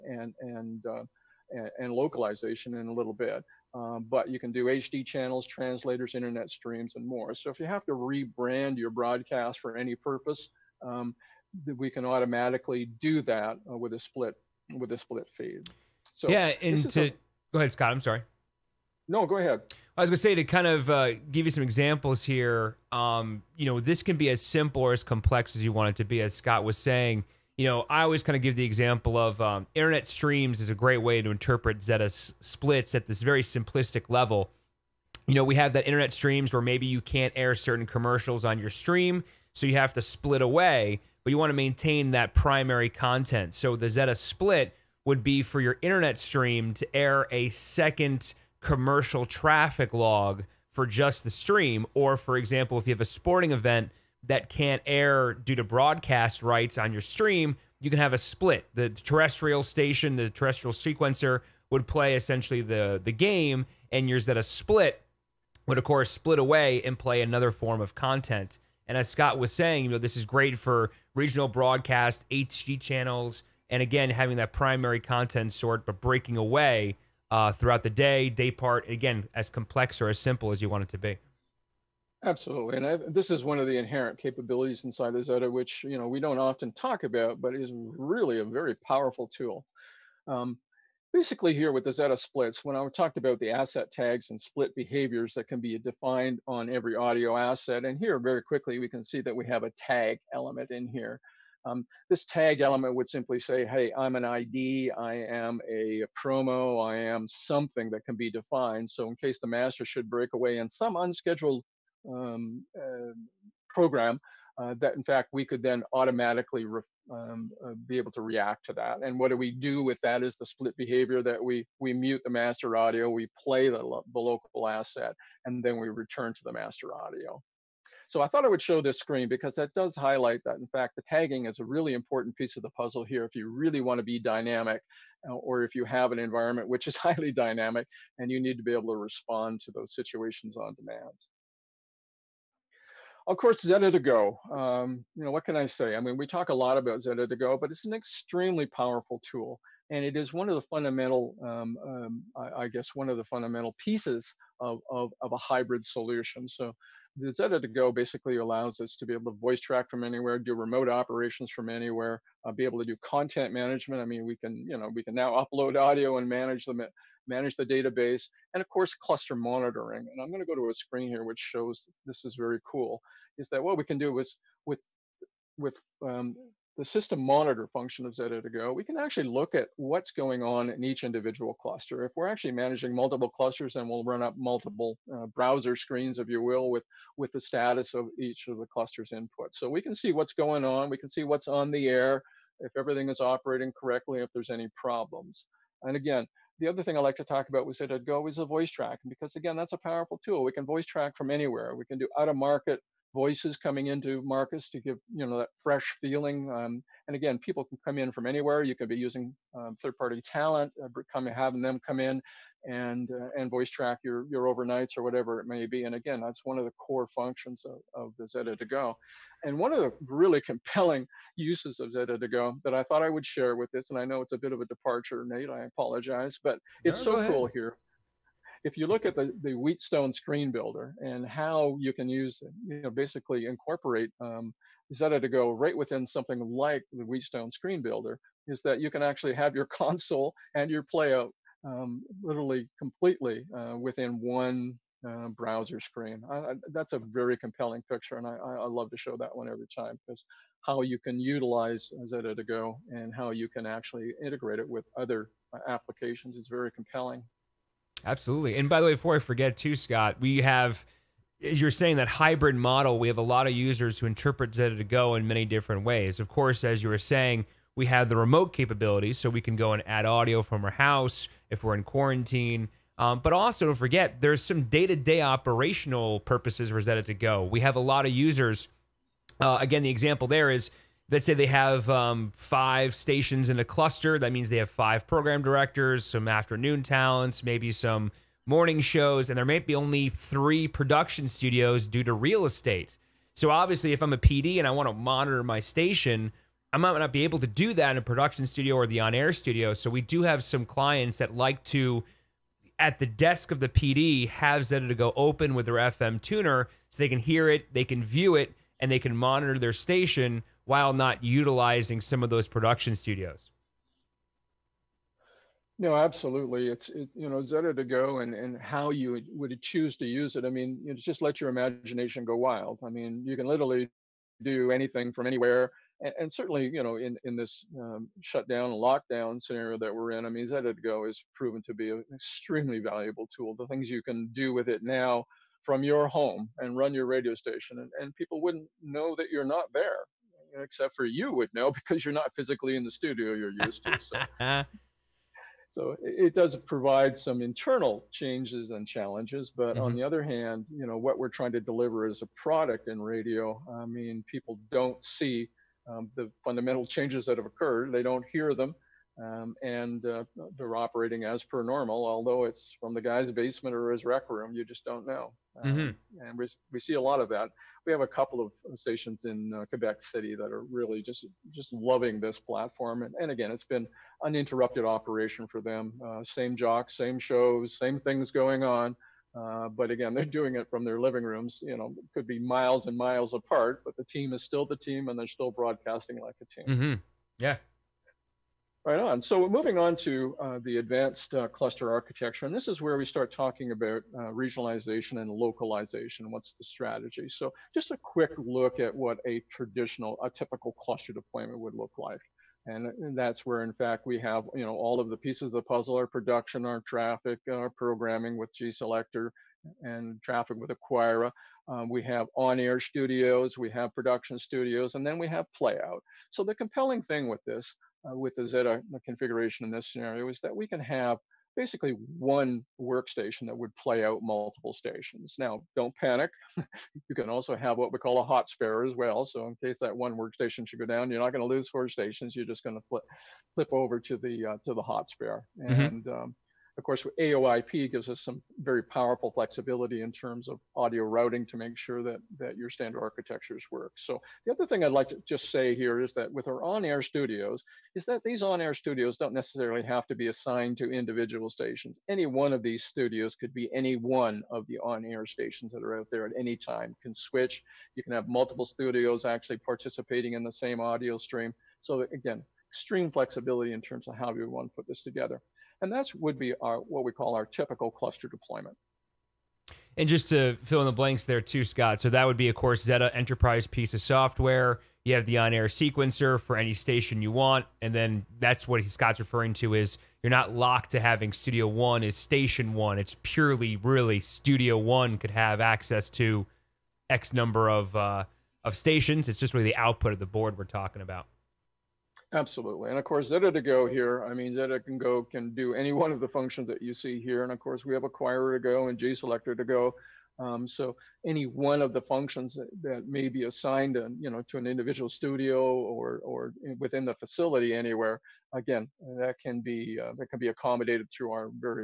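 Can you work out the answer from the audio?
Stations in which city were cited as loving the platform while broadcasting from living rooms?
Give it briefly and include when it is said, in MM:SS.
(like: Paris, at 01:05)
Quebec City, at 06:09.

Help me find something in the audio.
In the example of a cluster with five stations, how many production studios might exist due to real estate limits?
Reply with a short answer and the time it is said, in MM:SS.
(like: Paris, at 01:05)
3, at 04:50.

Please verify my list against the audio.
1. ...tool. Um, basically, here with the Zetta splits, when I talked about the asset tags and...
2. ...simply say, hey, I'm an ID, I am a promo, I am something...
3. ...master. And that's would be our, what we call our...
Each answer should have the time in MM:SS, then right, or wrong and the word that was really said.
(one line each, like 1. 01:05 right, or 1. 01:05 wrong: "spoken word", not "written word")
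1. 01:29 right
2. 01:43 right
3. 07:45 wrong: "together", not "master".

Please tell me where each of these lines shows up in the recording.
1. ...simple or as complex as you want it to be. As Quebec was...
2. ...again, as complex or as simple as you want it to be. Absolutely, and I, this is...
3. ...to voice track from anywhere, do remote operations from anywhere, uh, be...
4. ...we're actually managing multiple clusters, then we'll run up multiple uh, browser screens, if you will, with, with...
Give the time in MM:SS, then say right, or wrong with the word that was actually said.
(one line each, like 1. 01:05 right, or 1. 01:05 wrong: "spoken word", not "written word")
1. 00:24 wrong: "Scott", not "Quebec"
2. 01:18 right
3. 02:39 right
4. 03:02 right.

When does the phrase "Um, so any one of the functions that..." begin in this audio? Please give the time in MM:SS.
08:20.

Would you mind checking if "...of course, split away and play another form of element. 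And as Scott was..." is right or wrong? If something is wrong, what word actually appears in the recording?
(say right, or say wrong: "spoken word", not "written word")
wrong: "content", not "element".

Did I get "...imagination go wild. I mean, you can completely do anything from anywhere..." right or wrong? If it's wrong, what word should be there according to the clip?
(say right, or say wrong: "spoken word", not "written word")
wrong: "literally", not "completely".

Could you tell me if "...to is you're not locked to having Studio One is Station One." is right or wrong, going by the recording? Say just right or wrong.
right.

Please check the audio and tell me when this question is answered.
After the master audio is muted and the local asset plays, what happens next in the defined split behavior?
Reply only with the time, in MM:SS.
02:05.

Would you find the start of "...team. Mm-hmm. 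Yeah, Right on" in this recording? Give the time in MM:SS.
06:26.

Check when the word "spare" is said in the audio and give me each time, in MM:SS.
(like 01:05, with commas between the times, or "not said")
07:08, 07:15.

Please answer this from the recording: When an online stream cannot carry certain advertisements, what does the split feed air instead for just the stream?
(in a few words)
a second commercial traffic log.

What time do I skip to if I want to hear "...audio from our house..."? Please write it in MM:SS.
04:30.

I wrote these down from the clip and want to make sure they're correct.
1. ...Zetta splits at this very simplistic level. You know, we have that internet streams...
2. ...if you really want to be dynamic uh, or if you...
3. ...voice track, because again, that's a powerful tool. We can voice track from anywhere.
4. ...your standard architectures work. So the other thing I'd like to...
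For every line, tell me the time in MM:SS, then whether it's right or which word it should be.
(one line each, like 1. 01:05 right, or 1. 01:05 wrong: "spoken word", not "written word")
1. 00:31 right
2. 02:13 right
3. 03:18 right
4. 07:22 right.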